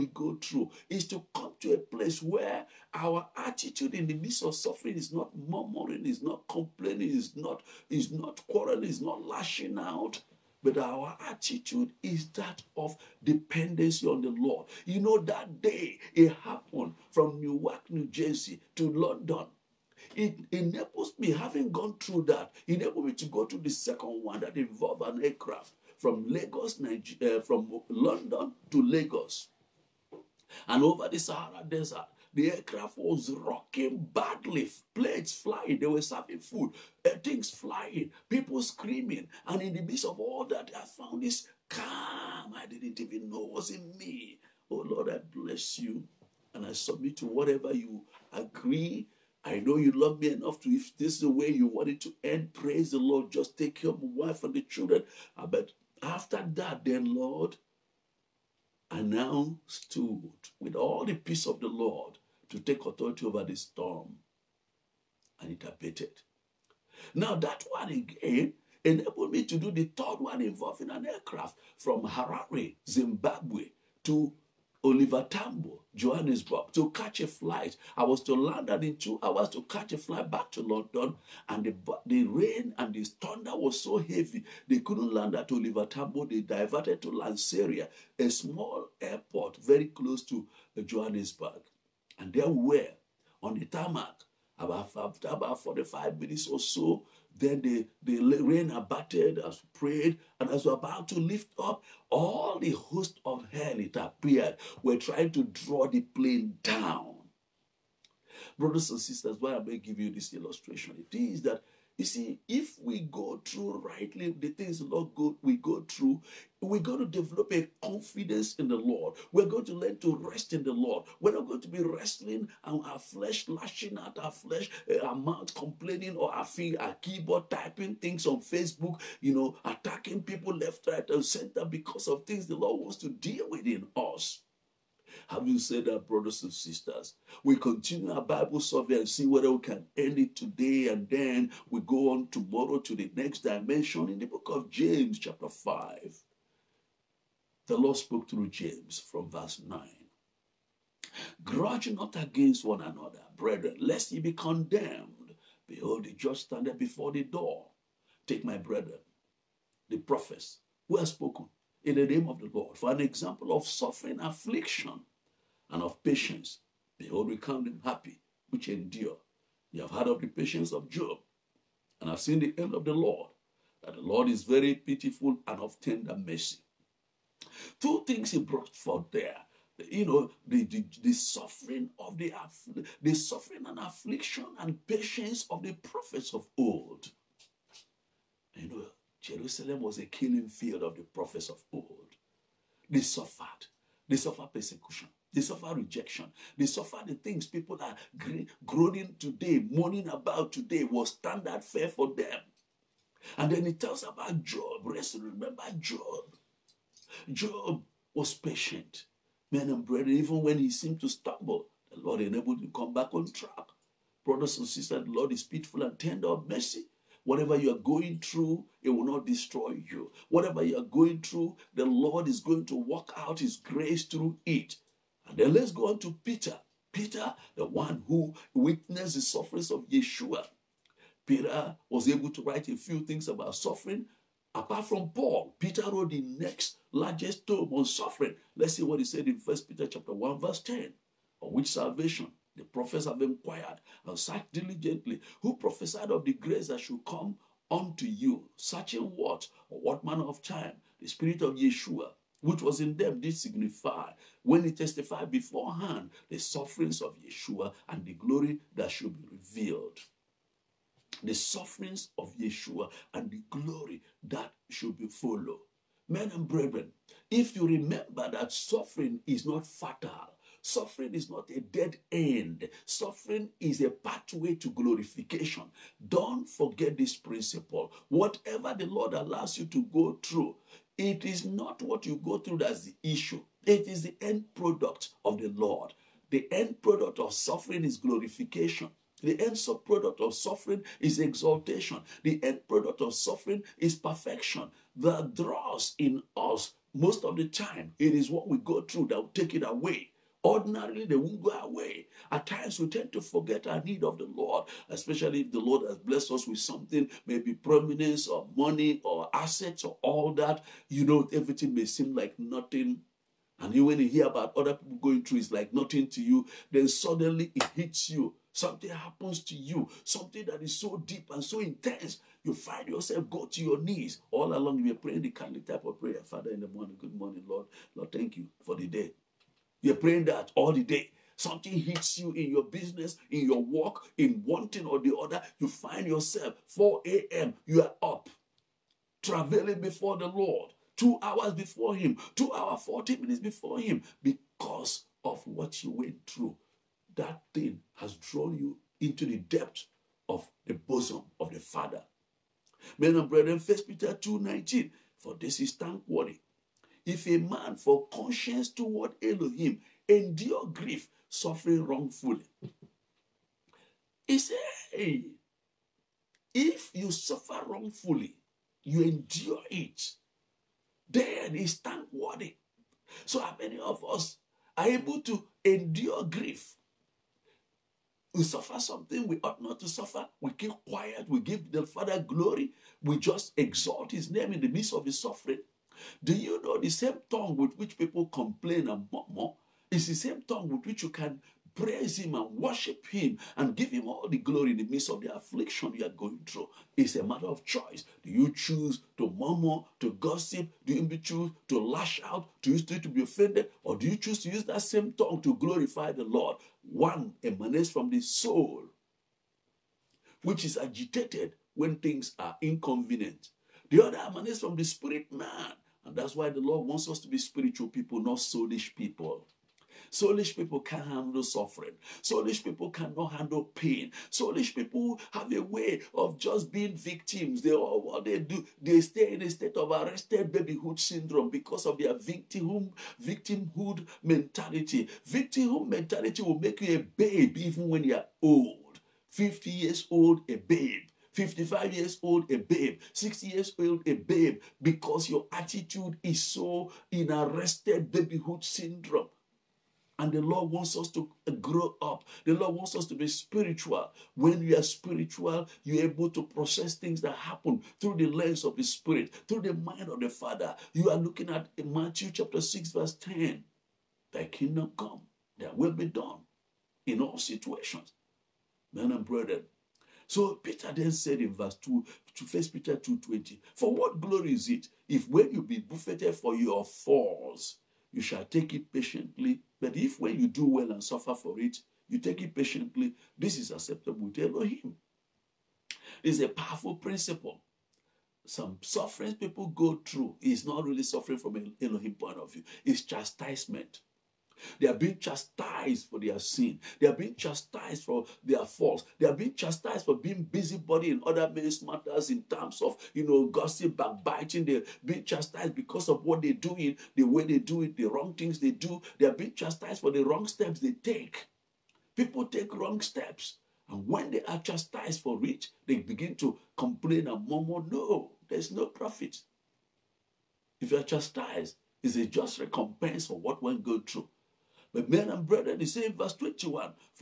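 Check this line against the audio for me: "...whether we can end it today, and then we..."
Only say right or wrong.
right.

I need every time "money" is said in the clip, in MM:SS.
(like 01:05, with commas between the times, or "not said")
05:08.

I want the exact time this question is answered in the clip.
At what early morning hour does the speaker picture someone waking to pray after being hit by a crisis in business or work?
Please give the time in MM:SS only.
05:36.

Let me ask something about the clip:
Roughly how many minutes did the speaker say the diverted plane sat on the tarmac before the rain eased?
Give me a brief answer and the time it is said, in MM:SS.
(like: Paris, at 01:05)
45, at 01:35.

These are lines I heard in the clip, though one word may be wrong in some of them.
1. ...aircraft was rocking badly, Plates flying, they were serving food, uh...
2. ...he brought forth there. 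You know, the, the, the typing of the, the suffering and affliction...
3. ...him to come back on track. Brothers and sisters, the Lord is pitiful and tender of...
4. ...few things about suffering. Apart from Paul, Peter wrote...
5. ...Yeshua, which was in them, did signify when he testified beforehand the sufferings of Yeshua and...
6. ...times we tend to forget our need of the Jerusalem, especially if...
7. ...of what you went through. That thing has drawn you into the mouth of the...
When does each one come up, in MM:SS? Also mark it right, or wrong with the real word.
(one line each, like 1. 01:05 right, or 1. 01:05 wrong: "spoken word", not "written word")
1. 00:32 right
2. 02:58 wrong: "suffering", not "typing"
3. 03:32 right
4. 03:52 right
5. 04:11 right
6. 05:02 wrong: "Lord", not "Jerusalem"
7. 05:45 wrong: "depth", not "mouth".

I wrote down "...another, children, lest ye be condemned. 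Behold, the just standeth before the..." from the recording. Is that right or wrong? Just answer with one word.
wrong.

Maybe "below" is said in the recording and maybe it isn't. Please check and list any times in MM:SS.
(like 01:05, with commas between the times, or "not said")
not said.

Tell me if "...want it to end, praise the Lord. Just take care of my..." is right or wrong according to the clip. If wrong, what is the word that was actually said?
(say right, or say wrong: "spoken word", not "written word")
right.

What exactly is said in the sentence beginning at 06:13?
So how many of us are able to endure grief?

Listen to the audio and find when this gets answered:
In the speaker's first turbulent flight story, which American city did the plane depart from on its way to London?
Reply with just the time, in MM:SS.
00:17.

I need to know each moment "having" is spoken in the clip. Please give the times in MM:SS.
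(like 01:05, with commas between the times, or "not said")
00:21, 02:15.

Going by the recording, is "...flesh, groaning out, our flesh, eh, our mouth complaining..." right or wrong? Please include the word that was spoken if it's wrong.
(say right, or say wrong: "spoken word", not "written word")
wrong: "lashing", not "groaning".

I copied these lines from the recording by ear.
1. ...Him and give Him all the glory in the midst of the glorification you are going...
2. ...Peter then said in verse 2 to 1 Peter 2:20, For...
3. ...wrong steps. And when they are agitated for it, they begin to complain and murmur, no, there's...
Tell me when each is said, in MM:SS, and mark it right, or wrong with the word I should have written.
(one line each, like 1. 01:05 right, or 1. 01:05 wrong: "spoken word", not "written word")
1. 06:33 wrong: "affliction", not "glorification"
2. 07:50 right
3. 08:32 wrong: "chastised", not "agitated".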